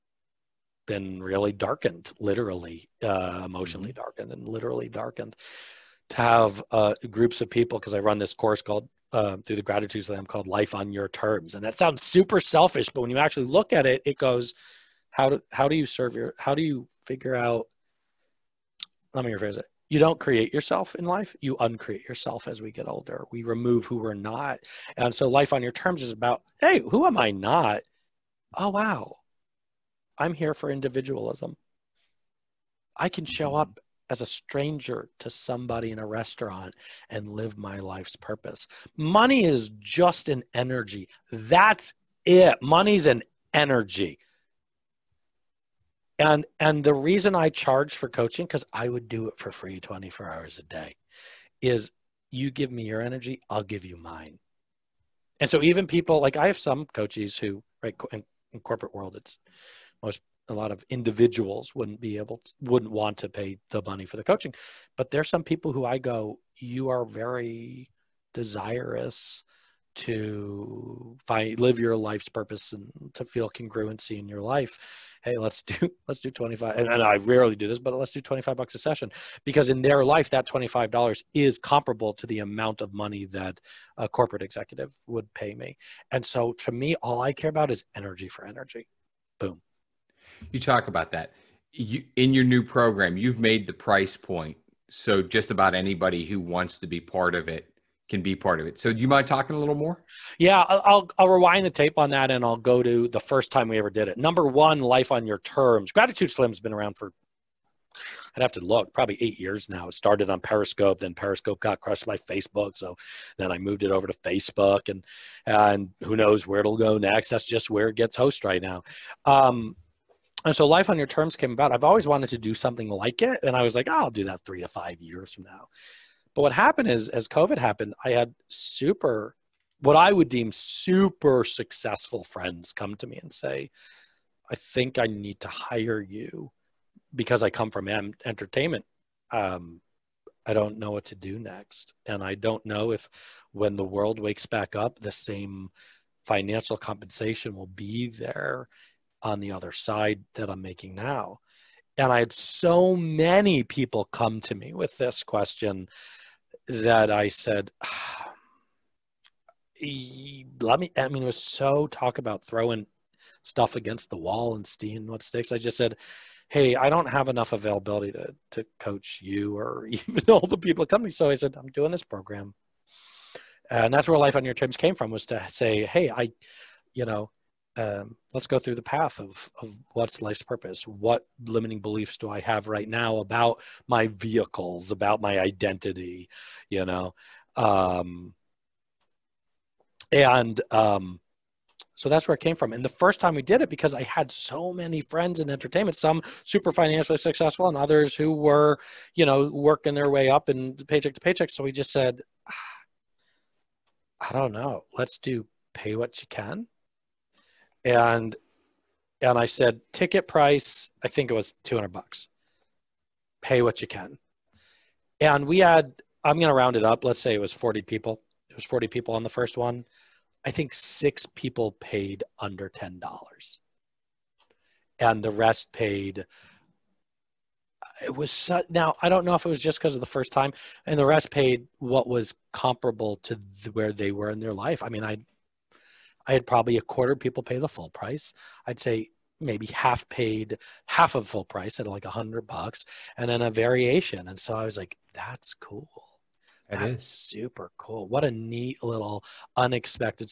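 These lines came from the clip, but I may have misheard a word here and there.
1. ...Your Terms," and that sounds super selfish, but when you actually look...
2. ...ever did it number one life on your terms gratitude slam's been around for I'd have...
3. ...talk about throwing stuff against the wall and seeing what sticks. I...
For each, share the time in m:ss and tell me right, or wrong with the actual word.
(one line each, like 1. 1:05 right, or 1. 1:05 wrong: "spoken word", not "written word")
1. 0:10 right
2. 1:43 right
3. 2:41 right.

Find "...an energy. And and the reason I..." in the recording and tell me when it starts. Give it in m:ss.
0:43.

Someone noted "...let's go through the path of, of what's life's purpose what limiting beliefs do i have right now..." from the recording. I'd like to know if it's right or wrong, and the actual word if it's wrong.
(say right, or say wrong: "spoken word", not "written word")
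right.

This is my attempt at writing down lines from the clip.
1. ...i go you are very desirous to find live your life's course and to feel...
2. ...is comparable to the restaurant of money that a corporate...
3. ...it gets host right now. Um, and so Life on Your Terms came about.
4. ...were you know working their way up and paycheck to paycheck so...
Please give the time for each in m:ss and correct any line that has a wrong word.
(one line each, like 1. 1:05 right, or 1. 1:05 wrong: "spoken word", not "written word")
1. 1:05 wrong: "purpose", not "course"
2. 1:21 wrong: "amount", not "restaurant"
3. 1:57 right
4. 3:18 right.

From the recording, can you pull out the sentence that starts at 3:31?
I think it was two hundred bucks.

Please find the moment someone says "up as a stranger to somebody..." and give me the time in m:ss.
0:33.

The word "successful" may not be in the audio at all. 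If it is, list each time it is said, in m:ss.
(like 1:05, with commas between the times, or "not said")
2:11, 3:17.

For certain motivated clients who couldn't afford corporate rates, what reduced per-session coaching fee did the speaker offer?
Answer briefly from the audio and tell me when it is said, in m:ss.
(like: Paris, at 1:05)
$25, at 1:18.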